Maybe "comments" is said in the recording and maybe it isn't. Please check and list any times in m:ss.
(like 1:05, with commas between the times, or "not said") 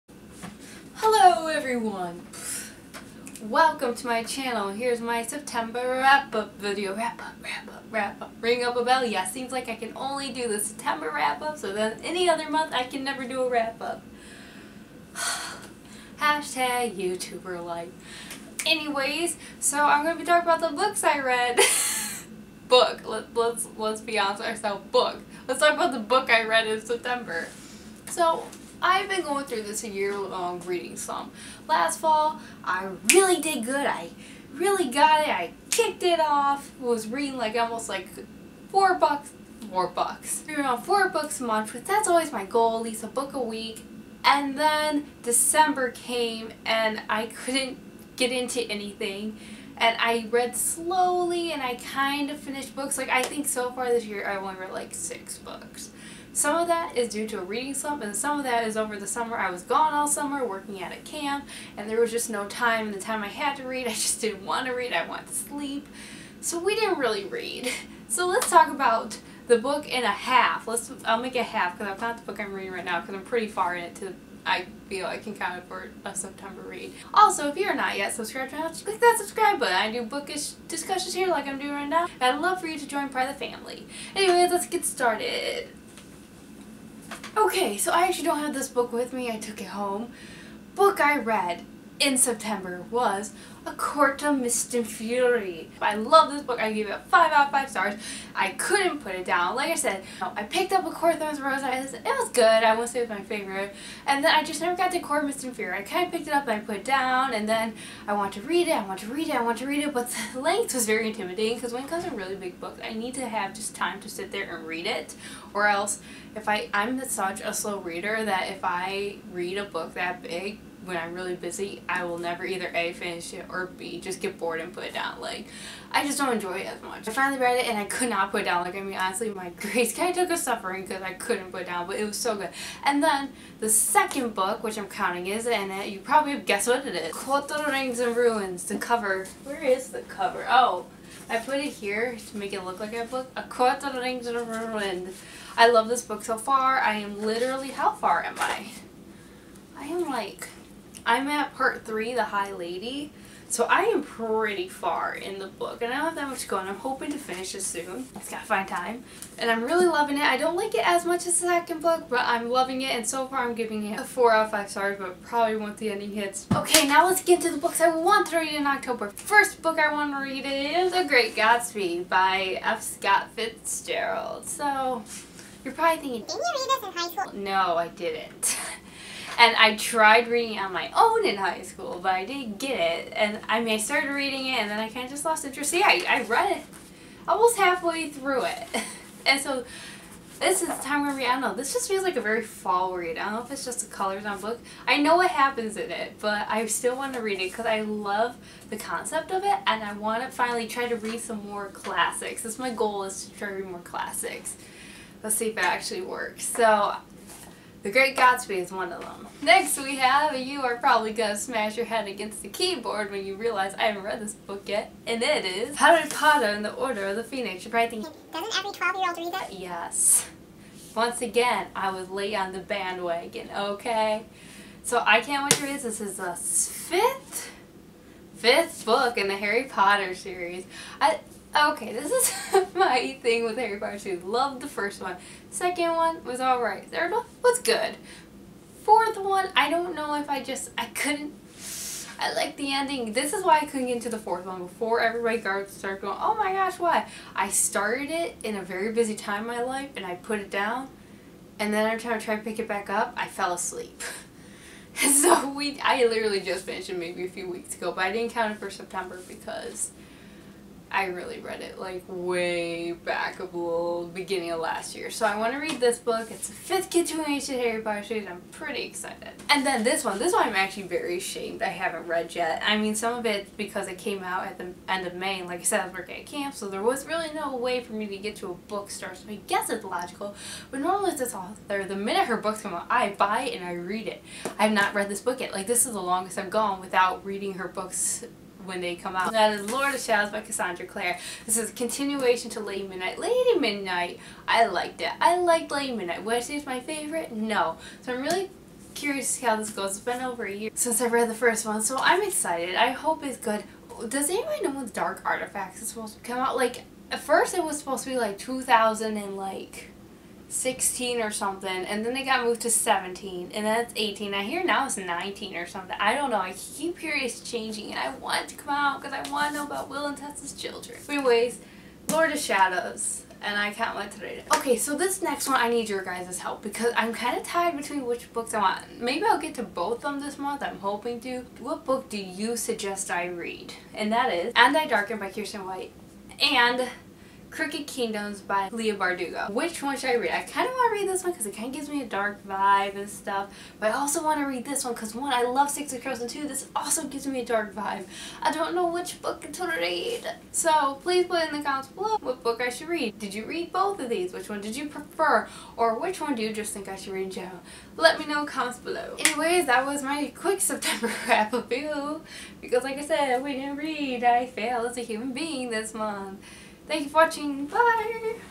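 5:51, 5:58.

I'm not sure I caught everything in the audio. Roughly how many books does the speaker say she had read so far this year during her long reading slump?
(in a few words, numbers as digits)
6.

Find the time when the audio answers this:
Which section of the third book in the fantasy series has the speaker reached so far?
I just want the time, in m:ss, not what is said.
2:32.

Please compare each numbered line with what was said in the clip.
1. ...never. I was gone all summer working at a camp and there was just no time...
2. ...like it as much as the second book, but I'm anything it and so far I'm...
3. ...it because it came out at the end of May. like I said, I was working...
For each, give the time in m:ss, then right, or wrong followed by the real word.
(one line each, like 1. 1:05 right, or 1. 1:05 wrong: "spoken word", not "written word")
1. 0:59 wrong: "summer", not "never"
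2. 2:40 wrong: "loving", not "anything"
3. 4:33 right.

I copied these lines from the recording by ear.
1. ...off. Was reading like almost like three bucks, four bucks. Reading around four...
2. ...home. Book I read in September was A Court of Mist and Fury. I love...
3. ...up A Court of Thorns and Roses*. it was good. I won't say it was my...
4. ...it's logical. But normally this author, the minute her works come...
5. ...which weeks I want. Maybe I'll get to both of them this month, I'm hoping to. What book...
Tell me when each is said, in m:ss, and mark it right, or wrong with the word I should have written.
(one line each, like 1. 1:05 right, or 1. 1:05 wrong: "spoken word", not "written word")
1. 0:36 wrong: "four", not "three"
2. 1:29 right
3. 1:40 right
4. 4:39 wrong: "books", not "works"
5. 5:28 wrong: "books", not "weeks".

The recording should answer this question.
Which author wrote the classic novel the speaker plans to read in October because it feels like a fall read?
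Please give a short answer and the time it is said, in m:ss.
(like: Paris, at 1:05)
F. Scott Fitzgerald, at 2:52.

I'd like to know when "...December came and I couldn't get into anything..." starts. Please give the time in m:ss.
0:45.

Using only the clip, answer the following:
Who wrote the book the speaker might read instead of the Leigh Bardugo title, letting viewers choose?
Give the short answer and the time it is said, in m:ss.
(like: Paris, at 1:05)
Kiersten White, at 5:35.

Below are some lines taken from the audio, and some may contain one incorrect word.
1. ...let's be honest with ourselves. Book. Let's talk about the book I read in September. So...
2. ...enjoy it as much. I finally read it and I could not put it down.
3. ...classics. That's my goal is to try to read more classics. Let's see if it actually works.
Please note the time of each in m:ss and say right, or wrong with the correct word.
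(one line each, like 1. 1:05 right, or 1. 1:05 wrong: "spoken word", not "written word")
1. 0:23 right
2. 2:06 right
3. 3:21 right.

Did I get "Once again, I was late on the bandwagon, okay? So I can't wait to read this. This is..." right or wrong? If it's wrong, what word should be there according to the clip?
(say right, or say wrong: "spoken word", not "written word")
right.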